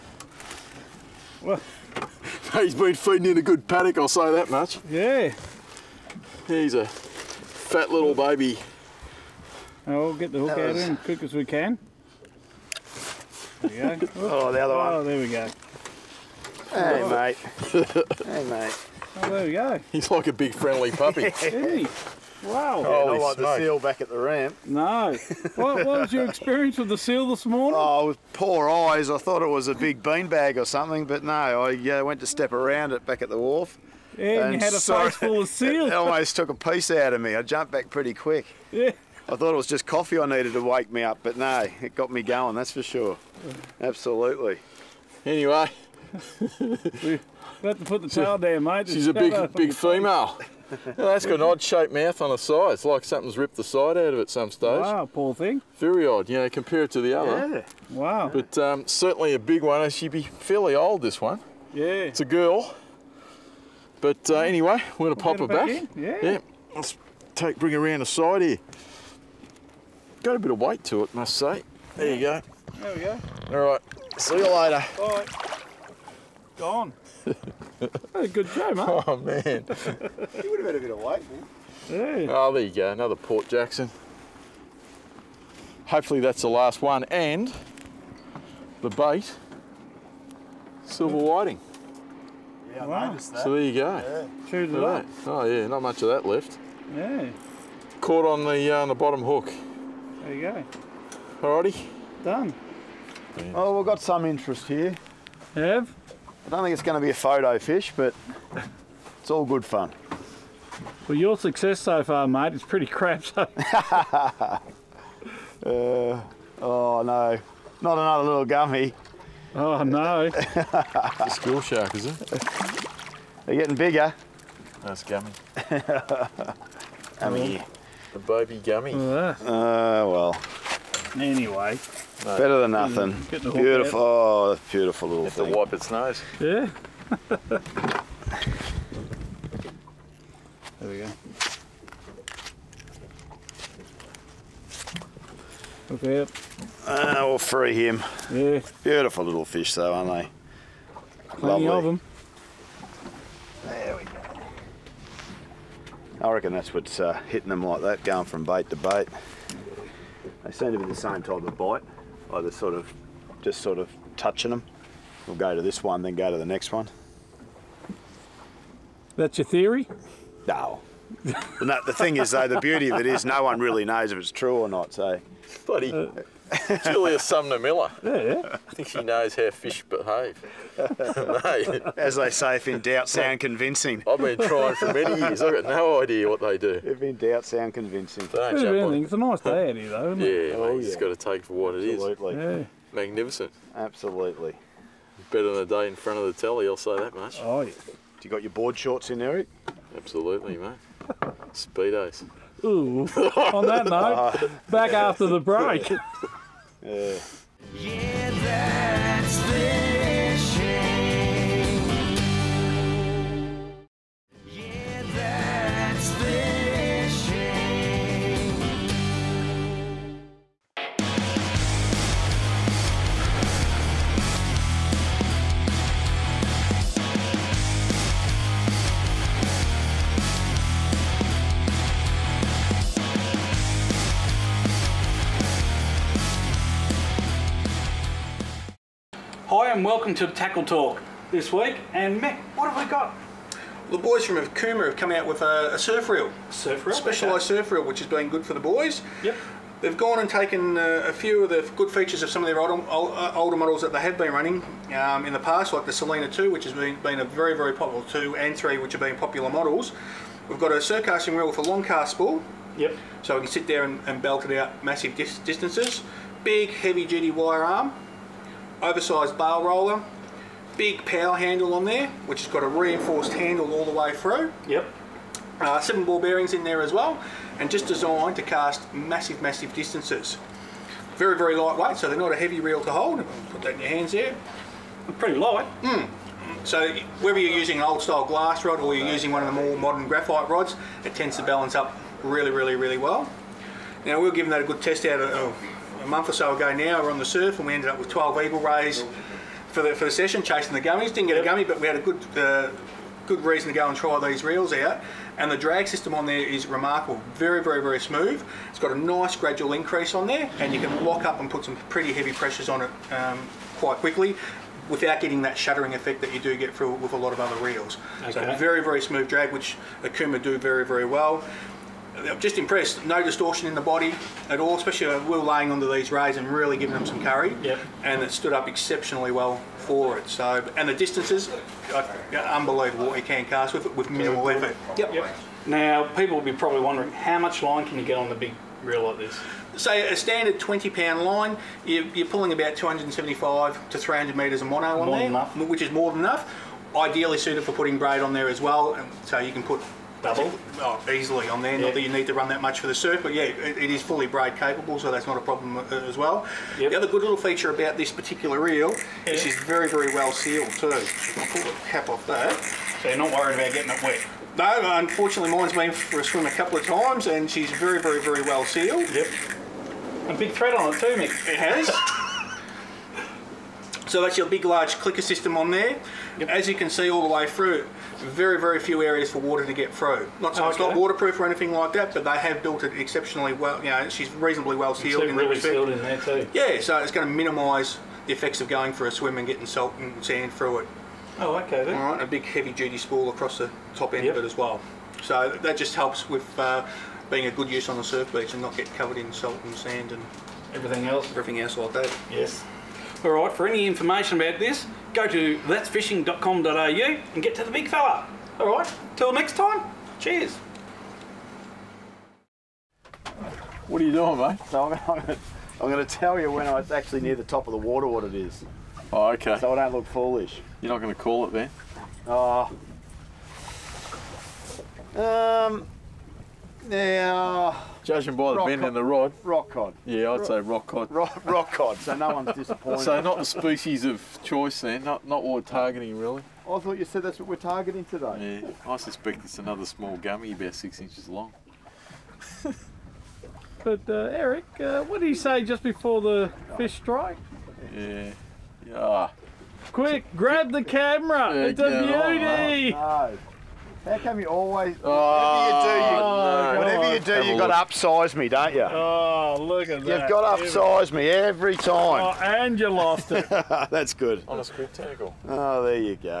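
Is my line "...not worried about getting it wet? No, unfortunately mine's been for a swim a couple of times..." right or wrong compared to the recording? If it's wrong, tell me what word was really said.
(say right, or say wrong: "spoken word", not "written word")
right.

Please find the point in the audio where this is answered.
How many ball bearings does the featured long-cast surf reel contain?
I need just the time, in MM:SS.
04:35.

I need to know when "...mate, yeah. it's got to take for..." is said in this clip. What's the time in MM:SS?
03:10.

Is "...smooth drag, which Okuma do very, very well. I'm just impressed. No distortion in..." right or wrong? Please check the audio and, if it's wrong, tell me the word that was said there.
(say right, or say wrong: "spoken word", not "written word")
right.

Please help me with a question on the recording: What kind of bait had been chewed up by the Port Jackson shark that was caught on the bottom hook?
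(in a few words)
silver whiting.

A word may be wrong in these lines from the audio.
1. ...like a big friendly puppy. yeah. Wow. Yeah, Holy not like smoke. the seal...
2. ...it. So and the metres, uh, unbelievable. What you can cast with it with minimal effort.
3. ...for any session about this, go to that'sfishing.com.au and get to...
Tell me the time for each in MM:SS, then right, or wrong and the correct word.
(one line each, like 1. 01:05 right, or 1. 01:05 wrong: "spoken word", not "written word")
1. 00:20 right
2. 05:30 wrong: "distances", not "metres"
3. 06:43 wrong: "information", not "session".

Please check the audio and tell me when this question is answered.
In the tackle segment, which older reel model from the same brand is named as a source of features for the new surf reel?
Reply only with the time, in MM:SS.
04:15.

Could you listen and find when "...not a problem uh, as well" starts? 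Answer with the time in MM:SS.
05:55.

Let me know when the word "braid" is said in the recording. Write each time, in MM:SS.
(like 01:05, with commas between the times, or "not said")
05:47, 05:54.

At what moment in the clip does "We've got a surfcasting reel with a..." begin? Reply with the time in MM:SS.
04:20.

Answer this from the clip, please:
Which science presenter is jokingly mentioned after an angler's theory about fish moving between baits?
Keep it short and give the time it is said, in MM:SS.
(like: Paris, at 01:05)
Julius Sumner Miller, at 02:56.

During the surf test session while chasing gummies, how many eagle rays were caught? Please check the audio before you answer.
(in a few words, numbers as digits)
12.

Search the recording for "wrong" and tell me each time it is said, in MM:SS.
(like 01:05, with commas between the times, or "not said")
not said.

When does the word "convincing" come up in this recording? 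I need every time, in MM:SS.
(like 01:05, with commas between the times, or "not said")
03:03, 03:07.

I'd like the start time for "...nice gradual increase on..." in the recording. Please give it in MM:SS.
05:08.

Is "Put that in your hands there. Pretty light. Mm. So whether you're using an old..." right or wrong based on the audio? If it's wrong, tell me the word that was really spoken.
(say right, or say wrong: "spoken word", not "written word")
right.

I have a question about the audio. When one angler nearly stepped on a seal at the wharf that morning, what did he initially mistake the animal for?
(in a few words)
a big beanbag.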